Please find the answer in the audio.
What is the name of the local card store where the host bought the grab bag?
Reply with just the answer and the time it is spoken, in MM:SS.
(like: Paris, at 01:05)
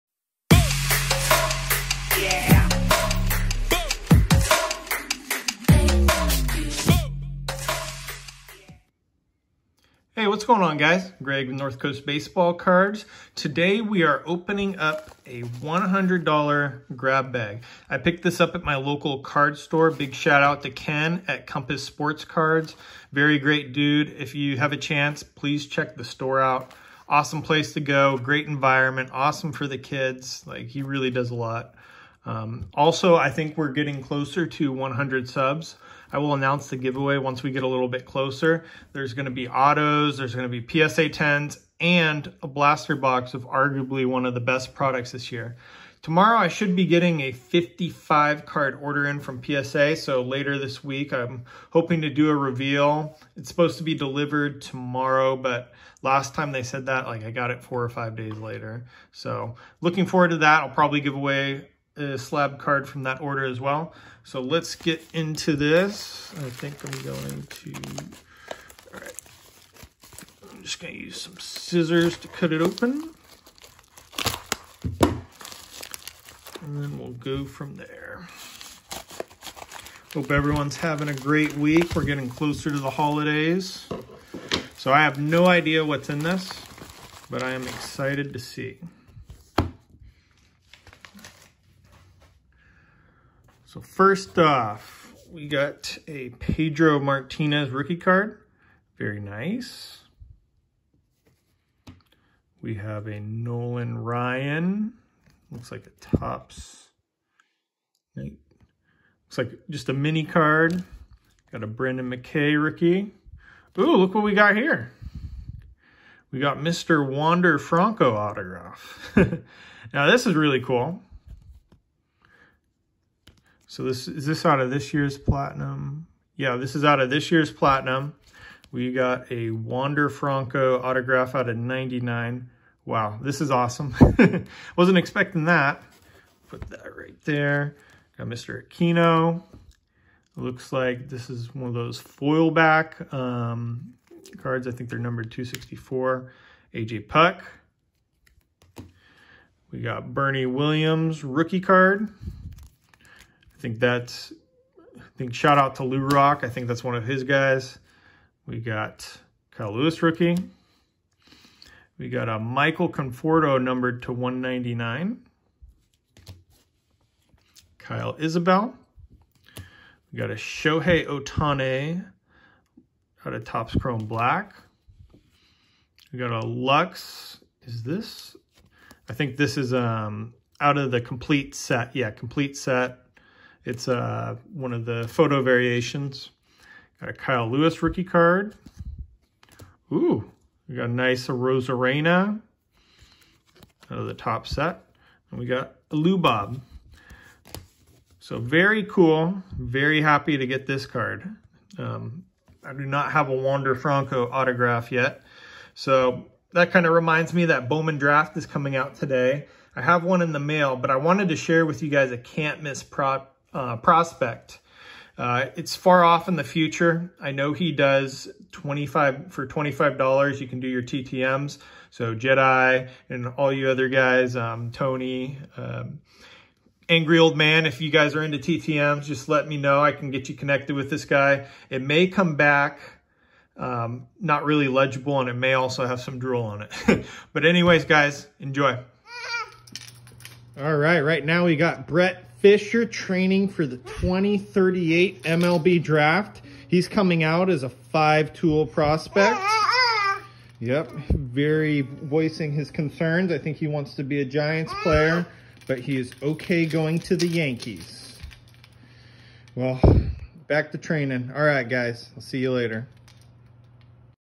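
Compass Sports Cards, at 00:21.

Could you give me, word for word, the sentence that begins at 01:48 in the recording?
Looks like just a mini card.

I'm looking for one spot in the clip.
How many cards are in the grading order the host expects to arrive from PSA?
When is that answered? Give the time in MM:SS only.
00:47.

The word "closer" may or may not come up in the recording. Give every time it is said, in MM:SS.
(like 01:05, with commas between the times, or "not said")
00:34, 00:38, 01:22.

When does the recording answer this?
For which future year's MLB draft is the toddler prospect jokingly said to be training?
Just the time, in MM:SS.
04:03.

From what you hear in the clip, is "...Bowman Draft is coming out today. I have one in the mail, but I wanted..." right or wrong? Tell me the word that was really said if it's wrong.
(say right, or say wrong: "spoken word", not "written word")
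right.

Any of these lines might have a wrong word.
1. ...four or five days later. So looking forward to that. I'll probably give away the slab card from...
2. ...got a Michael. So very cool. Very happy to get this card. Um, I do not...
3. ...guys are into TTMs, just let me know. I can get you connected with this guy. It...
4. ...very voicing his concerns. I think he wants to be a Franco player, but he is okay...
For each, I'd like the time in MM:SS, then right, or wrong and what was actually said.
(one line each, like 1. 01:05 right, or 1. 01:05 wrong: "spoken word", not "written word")
1. 00:57 right
2. 03:15 wrong: "Lubob", not "Michael"
3. 03:47 right
4. 04:11 wrong: "Giants", not "Franco".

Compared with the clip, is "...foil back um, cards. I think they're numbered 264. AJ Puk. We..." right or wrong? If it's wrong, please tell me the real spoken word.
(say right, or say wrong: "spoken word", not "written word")
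right.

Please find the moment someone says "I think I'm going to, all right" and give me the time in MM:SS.
01:06.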